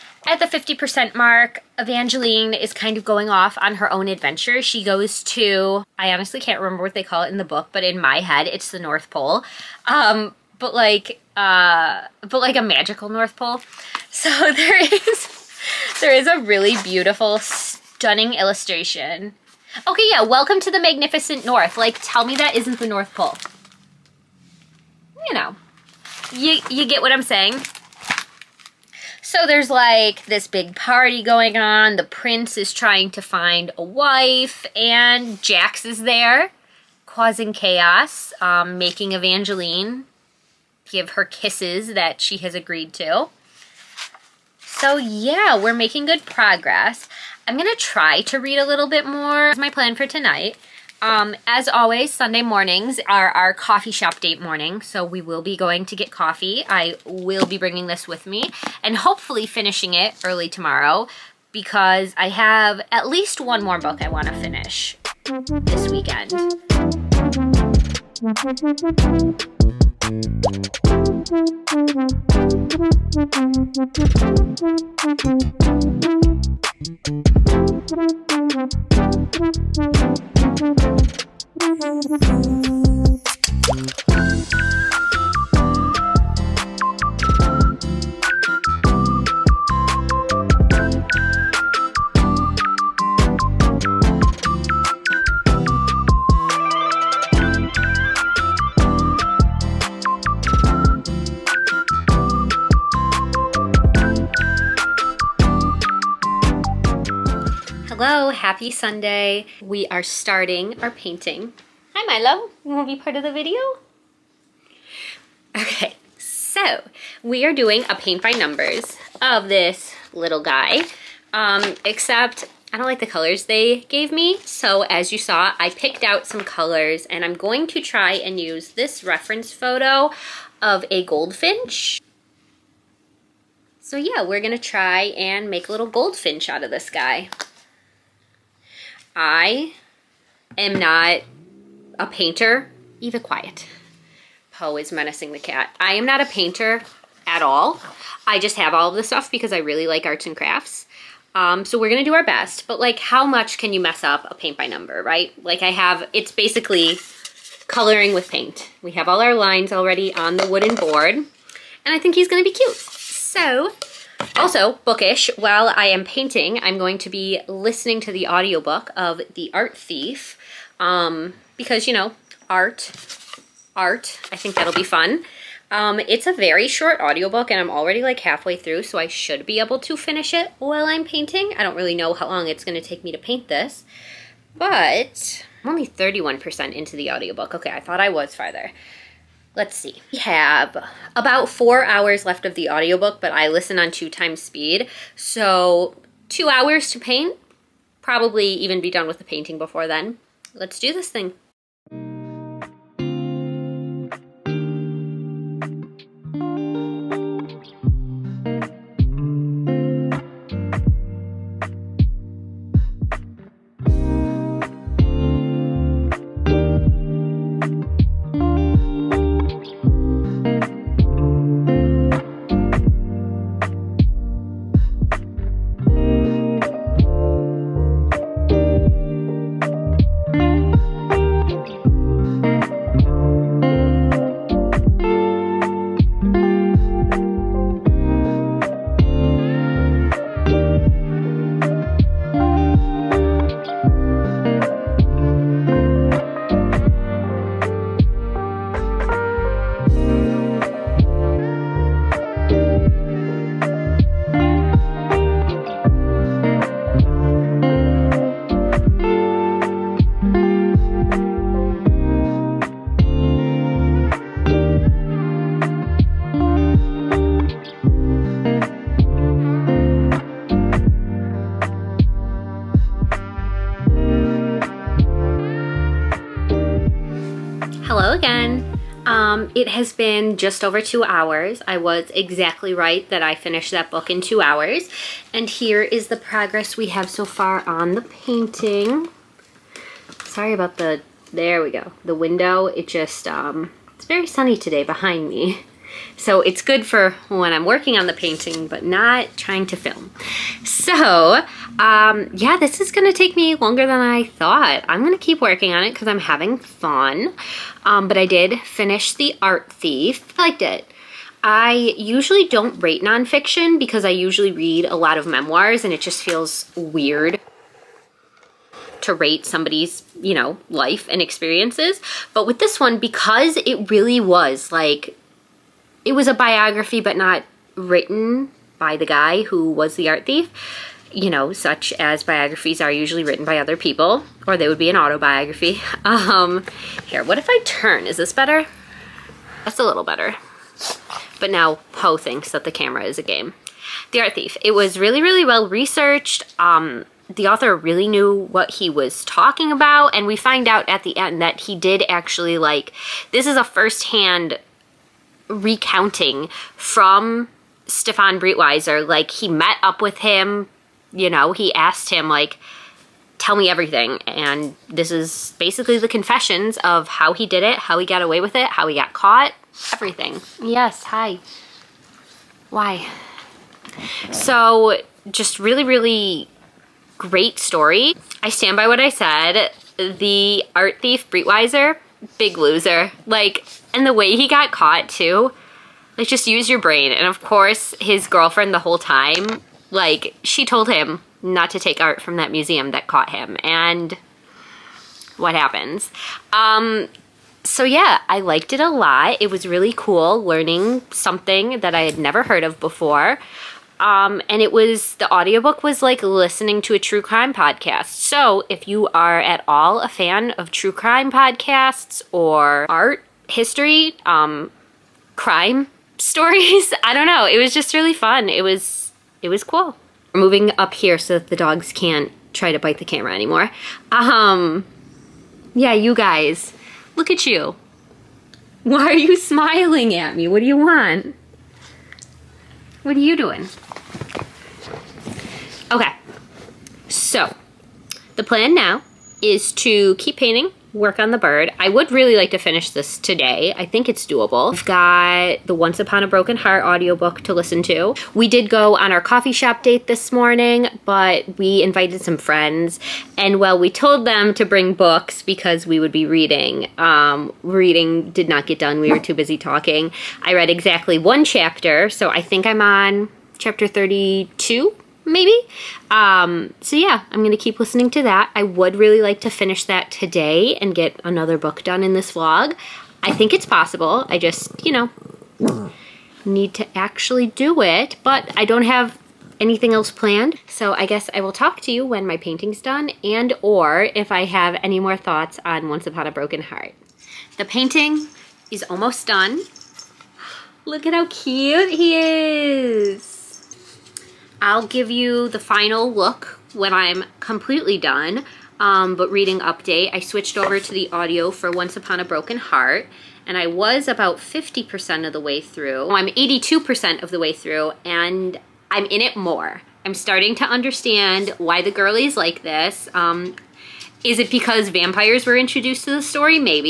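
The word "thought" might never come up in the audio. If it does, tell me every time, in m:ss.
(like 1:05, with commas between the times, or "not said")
3:07, 5:04, 8:05.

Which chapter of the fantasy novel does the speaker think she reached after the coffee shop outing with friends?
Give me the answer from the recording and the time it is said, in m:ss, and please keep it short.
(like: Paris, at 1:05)
Chapter 32, at 7:43.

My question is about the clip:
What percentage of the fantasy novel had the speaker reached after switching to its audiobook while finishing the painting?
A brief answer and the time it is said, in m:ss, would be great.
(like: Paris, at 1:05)
82%, at 8:26.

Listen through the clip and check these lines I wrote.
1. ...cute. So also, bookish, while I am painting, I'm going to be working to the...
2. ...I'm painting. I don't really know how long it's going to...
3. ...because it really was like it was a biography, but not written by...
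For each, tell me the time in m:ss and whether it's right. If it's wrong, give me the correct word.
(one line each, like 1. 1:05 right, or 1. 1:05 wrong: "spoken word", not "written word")
1. 2:42 wrong: "listening", not "working"
2. 3:00 right
3. 5:22 right.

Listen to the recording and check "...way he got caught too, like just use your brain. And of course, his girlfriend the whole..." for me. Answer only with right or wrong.
right.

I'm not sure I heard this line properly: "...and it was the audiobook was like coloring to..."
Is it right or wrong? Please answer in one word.
wrong.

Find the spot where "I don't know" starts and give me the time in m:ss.
6:57.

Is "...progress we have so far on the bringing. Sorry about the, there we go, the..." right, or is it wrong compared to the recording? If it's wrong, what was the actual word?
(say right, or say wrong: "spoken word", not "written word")
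wrong: "painting", not "bringing".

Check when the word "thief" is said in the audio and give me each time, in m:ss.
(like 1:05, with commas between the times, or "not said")
2:49, 5:09, 5:30, 5:44, 6:21.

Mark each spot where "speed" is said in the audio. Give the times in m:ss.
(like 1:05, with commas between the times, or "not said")
3:14.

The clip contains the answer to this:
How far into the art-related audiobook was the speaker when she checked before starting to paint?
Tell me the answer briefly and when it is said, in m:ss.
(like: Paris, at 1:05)
31%, at 3:05.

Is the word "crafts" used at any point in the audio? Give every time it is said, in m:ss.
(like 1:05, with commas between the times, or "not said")
2:30.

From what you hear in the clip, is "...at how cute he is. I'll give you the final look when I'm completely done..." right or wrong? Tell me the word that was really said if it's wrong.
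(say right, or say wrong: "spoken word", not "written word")
right.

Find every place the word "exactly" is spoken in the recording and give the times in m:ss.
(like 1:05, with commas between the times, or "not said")
4:42, 7:40.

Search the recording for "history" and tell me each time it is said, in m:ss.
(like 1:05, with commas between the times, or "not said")
6:53.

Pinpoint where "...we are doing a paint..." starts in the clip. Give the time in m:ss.
1:57.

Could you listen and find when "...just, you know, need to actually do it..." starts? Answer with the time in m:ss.
7:54.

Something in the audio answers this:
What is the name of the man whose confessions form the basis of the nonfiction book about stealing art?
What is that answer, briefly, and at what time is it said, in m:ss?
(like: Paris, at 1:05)
Stefan Breitwieser, at 5:57.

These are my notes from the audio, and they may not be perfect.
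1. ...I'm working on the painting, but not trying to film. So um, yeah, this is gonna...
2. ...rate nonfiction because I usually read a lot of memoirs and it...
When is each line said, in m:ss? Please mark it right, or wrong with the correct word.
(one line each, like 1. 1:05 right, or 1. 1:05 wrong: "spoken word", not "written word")
1. 4:57 right
2. 5:12 right.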